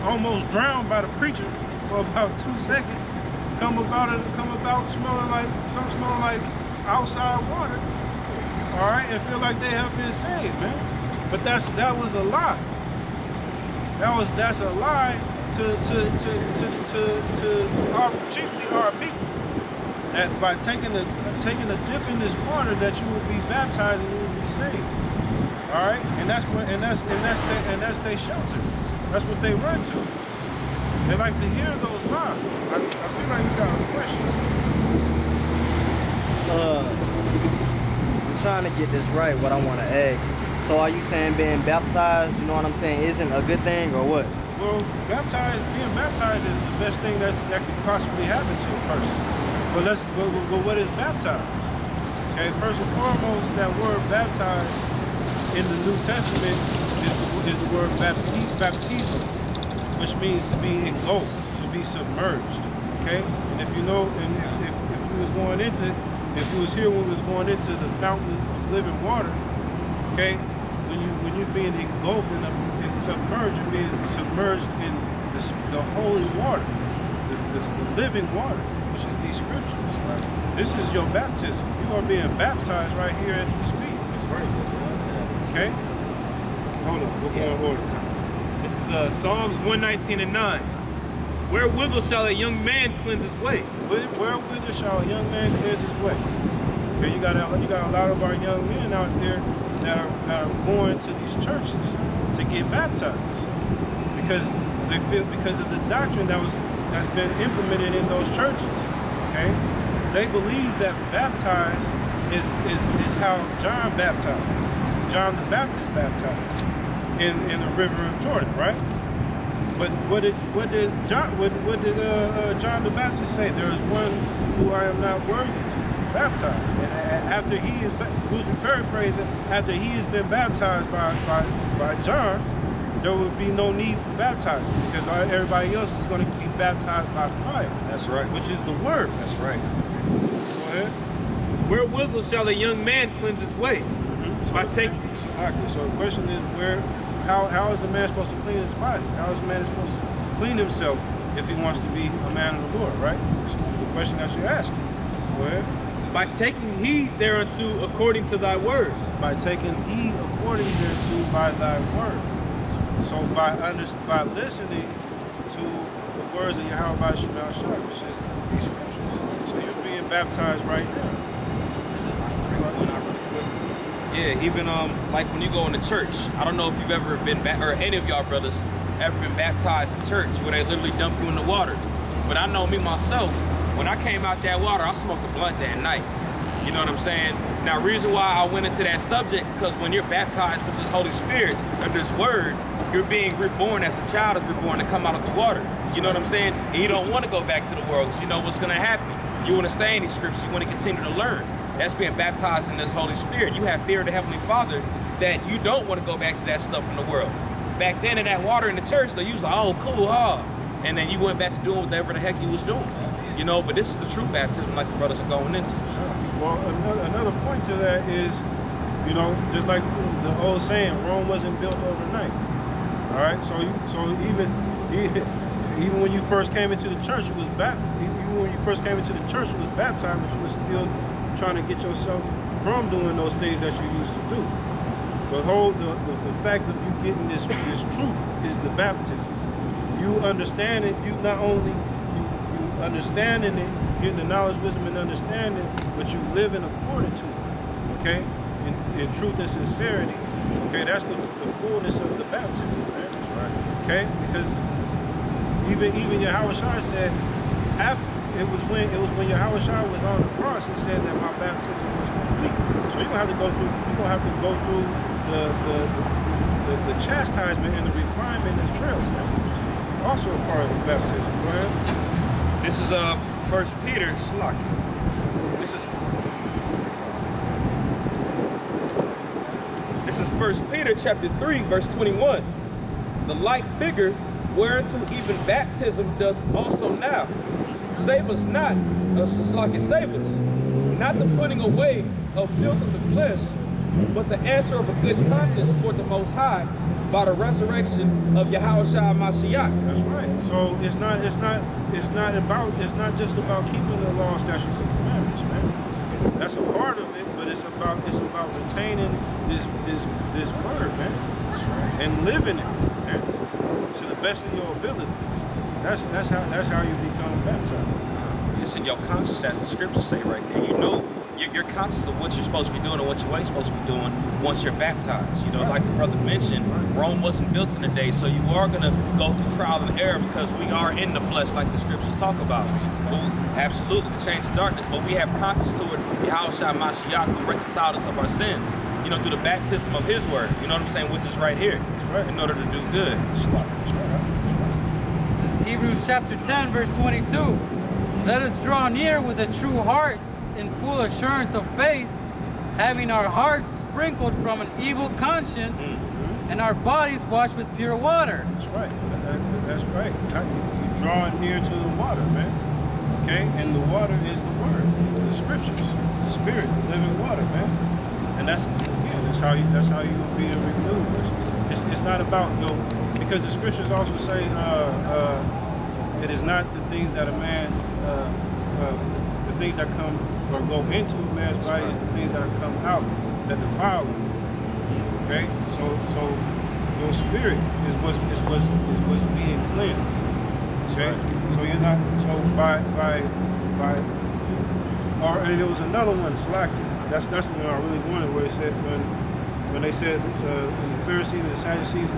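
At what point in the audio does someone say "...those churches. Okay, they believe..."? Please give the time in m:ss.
1:48.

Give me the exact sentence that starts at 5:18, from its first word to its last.
It's in your conscience, as the scriptures say right there.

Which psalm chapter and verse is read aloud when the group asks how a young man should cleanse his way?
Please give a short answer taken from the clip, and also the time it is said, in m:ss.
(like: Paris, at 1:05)
Psalms 119:9, at 1:29.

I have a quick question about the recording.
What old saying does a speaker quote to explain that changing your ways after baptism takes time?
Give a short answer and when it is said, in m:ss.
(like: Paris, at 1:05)
Rome wasn't built overnight, at 3:41.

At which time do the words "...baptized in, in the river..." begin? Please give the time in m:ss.
1:55.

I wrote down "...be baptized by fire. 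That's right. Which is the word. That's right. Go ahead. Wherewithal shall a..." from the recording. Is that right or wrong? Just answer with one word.
right.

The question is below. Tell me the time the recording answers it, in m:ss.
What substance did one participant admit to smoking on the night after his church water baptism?
3:05.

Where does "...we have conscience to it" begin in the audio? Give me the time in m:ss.
5:35.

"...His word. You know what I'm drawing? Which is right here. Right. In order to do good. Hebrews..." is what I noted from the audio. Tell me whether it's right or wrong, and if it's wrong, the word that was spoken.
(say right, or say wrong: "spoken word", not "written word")
wrong: "saying", not "drawing".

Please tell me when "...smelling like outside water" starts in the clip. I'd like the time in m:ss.
0:05.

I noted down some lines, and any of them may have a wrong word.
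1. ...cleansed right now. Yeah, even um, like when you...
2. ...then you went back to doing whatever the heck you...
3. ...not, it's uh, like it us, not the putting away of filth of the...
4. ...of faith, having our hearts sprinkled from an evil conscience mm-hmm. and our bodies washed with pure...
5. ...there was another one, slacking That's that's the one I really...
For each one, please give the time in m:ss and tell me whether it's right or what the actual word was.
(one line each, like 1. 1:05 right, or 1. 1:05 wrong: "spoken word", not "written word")
1. 2:50 wrong: "baptized", not "cleansed"
2. 3:30 right
3. 4:48 right
4. 5:51 right
5. 6:35 right.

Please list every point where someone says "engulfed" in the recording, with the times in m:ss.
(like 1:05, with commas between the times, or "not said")
1:00, 1:11.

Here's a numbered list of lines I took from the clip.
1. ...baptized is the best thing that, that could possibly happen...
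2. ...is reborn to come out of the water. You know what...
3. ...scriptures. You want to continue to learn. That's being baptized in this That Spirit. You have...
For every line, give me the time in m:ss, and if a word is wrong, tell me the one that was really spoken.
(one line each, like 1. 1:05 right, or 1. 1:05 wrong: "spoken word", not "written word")
1. 0:45 right
2. 3:14 right
3. 3:20 wrong: "Holy", not "That".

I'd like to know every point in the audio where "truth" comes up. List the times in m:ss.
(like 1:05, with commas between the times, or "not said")
3:57, 4:09.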